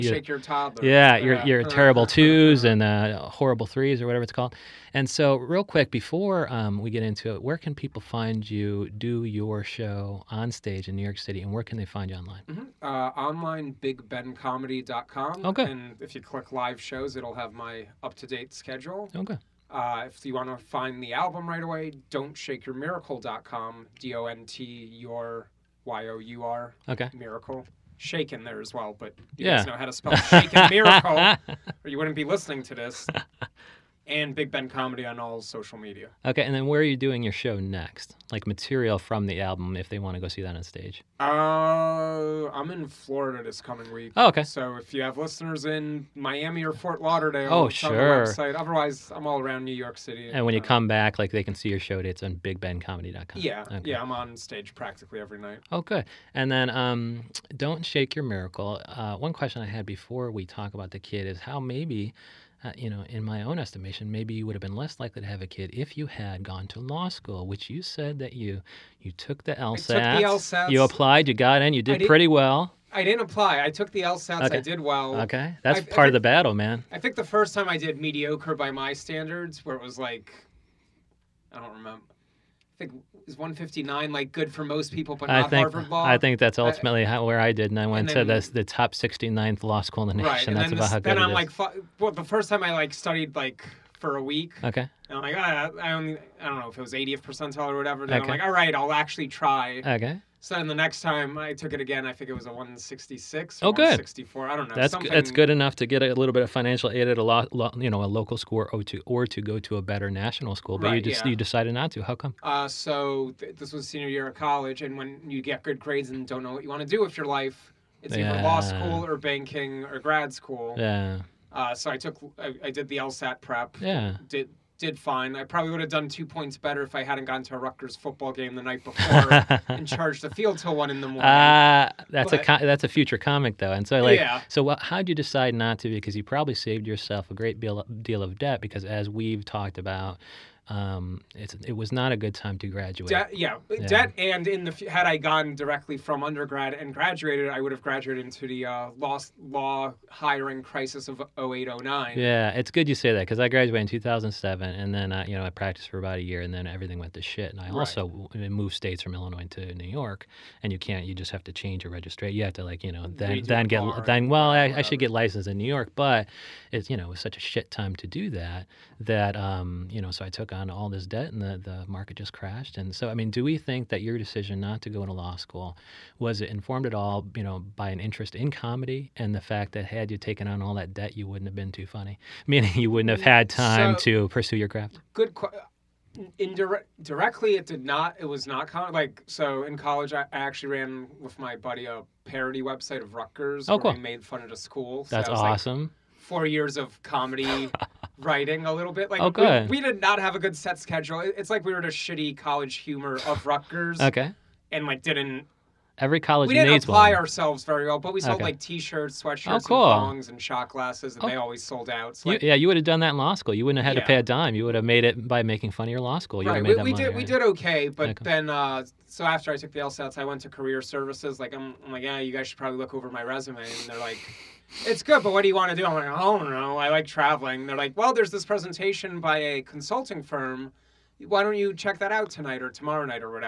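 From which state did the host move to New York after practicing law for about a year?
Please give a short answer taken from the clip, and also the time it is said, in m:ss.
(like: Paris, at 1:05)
Illinois, at 2:39.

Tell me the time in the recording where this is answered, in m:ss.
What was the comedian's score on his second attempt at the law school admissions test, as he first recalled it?
1:42.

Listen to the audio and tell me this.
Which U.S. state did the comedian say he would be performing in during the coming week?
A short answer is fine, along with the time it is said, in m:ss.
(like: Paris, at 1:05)
Florida, at 0:42.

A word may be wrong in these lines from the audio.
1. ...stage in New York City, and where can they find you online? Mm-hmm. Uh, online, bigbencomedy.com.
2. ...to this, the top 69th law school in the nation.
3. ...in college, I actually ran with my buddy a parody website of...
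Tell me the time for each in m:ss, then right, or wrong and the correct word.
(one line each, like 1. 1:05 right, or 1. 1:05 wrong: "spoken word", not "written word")
1. 0:10 right
2. 1:28 right
3. 3:09 right.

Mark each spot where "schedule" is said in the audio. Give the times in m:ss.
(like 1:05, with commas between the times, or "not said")
0:18, 3:20.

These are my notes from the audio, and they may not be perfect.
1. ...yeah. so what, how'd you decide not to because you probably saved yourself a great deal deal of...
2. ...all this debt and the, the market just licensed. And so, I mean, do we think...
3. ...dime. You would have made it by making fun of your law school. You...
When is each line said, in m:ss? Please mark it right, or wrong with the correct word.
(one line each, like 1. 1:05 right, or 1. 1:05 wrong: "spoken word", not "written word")
1. 2:14 right
2. 2:50 wrong: "crashed", not "licensed"
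3. 3:34 right.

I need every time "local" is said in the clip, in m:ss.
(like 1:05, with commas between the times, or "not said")
1:48.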